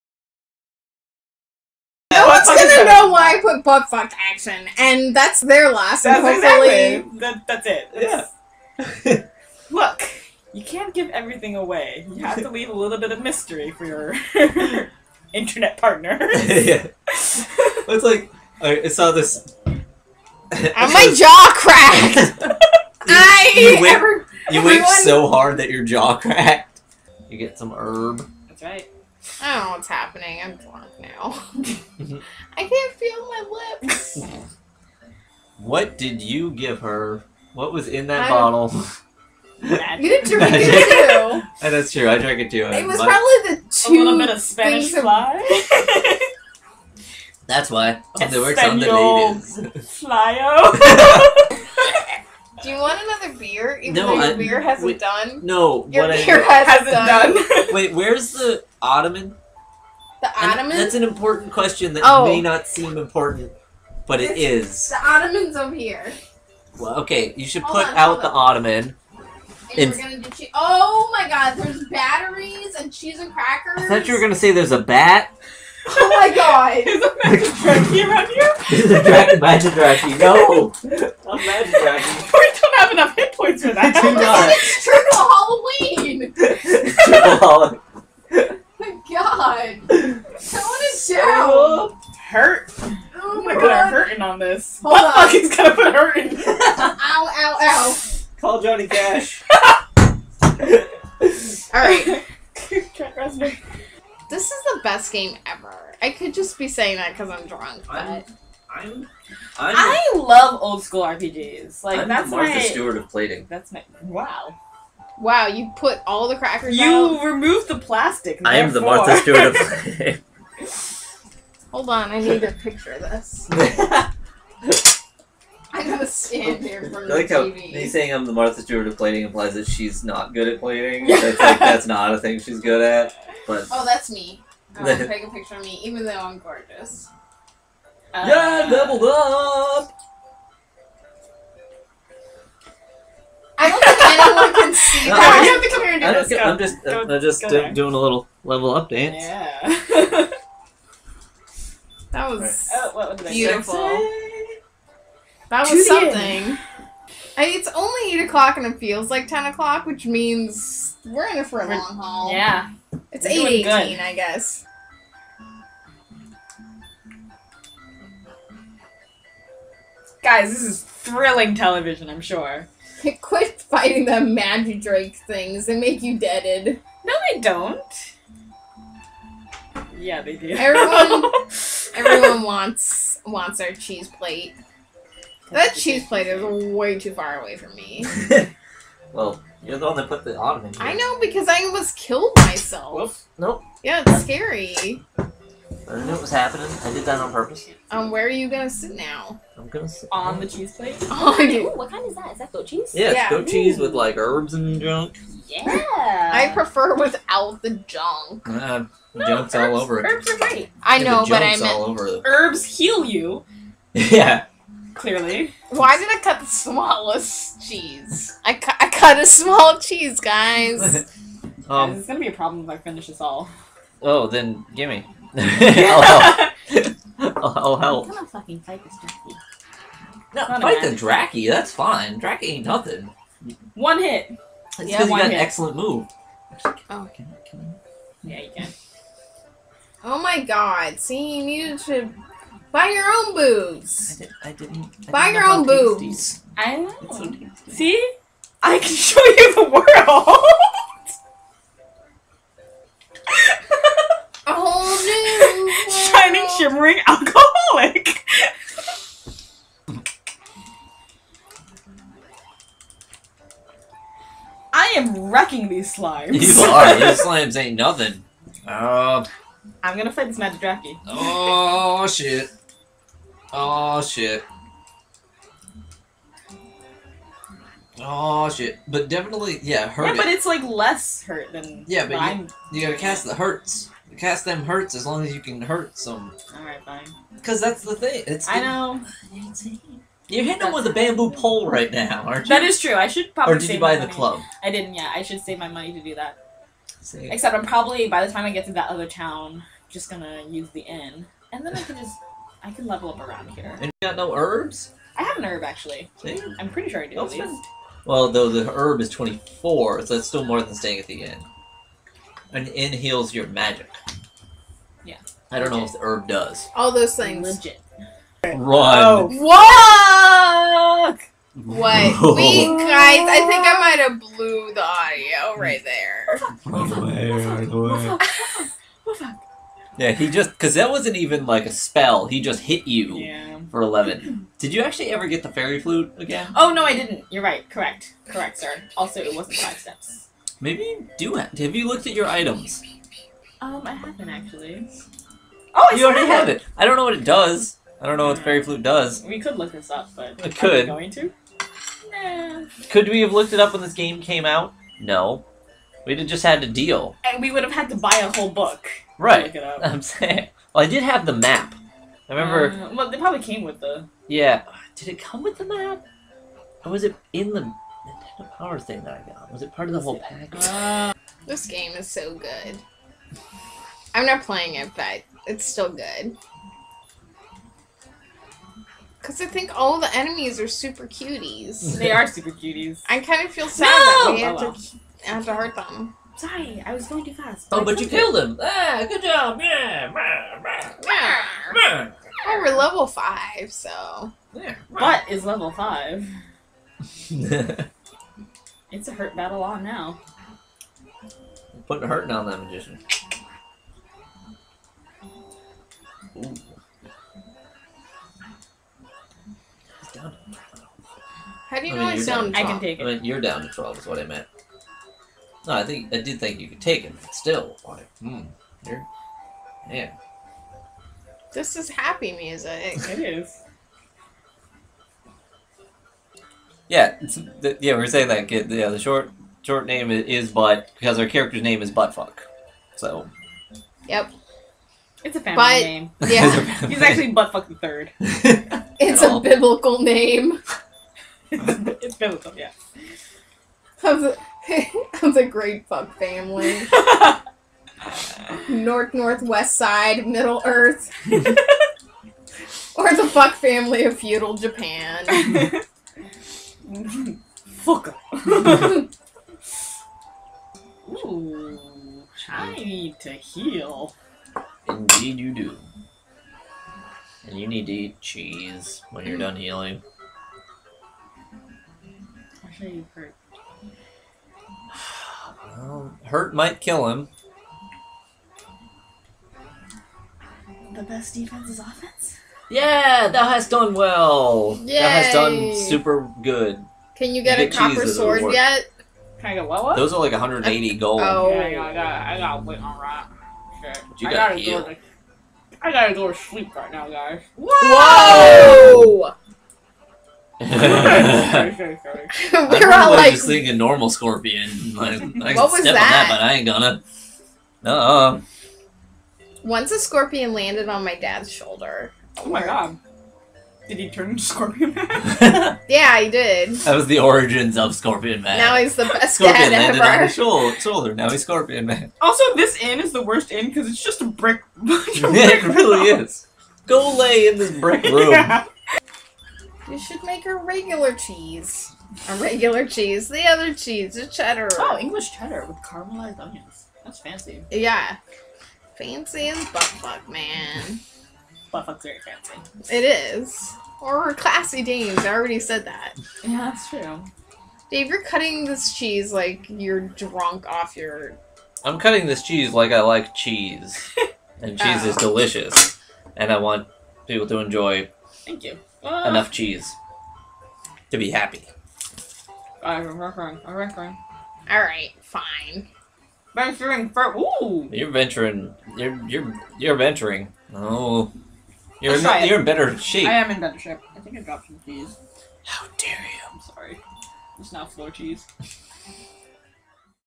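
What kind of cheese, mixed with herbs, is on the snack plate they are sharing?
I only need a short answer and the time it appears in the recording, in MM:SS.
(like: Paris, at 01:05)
Goat cheese, at 03:22.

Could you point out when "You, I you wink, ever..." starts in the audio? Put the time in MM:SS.
00:23.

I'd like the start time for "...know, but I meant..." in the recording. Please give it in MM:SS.
03:31.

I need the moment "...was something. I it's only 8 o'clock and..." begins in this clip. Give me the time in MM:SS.
02:35.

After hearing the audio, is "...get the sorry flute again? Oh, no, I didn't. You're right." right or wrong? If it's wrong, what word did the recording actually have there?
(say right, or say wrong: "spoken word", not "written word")
wrong: "fairy", not "sorry".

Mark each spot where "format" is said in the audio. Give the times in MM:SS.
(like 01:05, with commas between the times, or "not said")
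not said.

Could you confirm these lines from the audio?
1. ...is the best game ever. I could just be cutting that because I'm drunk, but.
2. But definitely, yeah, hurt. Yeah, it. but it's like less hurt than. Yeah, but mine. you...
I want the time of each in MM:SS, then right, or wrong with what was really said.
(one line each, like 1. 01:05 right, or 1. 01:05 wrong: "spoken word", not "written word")
1. 01:44 wrong: "saying", not "cutting"
2. 04:38 right.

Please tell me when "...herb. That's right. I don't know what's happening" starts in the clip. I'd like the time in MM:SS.
00:27.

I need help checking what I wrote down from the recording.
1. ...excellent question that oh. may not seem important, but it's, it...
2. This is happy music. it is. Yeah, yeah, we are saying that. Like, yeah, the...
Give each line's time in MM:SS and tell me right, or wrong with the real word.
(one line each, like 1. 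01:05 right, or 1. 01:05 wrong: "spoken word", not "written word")
1. 01:01 wrong: "important", not "excellent"
2. 07:01 right.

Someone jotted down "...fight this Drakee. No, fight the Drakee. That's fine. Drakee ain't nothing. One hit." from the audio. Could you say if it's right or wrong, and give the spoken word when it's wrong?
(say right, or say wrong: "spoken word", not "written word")
right.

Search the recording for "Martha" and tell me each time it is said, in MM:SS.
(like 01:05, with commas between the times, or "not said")
01:52, 01:58, 02:08.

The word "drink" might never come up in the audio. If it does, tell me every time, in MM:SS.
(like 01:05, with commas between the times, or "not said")
00:40, 02:54.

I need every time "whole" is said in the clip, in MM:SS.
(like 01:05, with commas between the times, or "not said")
04:14, 05:58, 06:09.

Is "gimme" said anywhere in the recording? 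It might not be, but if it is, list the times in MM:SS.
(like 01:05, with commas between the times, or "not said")
03:44.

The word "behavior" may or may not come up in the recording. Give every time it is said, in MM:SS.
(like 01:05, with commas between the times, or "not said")
not said.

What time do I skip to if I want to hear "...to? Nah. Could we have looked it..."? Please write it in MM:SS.
05:51.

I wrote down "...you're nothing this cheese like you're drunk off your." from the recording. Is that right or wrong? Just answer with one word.
wrong.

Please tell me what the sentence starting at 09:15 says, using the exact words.
is delicious, and I want people to enjoy.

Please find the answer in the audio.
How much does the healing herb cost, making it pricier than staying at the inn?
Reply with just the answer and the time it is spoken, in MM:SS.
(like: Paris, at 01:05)
24, at 05:09.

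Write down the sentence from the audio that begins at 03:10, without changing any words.
I know because I almost killed myself.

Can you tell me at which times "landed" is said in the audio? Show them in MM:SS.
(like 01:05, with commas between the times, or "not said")
08:30, 08:39.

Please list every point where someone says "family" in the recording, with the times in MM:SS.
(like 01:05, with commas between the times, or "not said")
07:15, 07:26, 07:33.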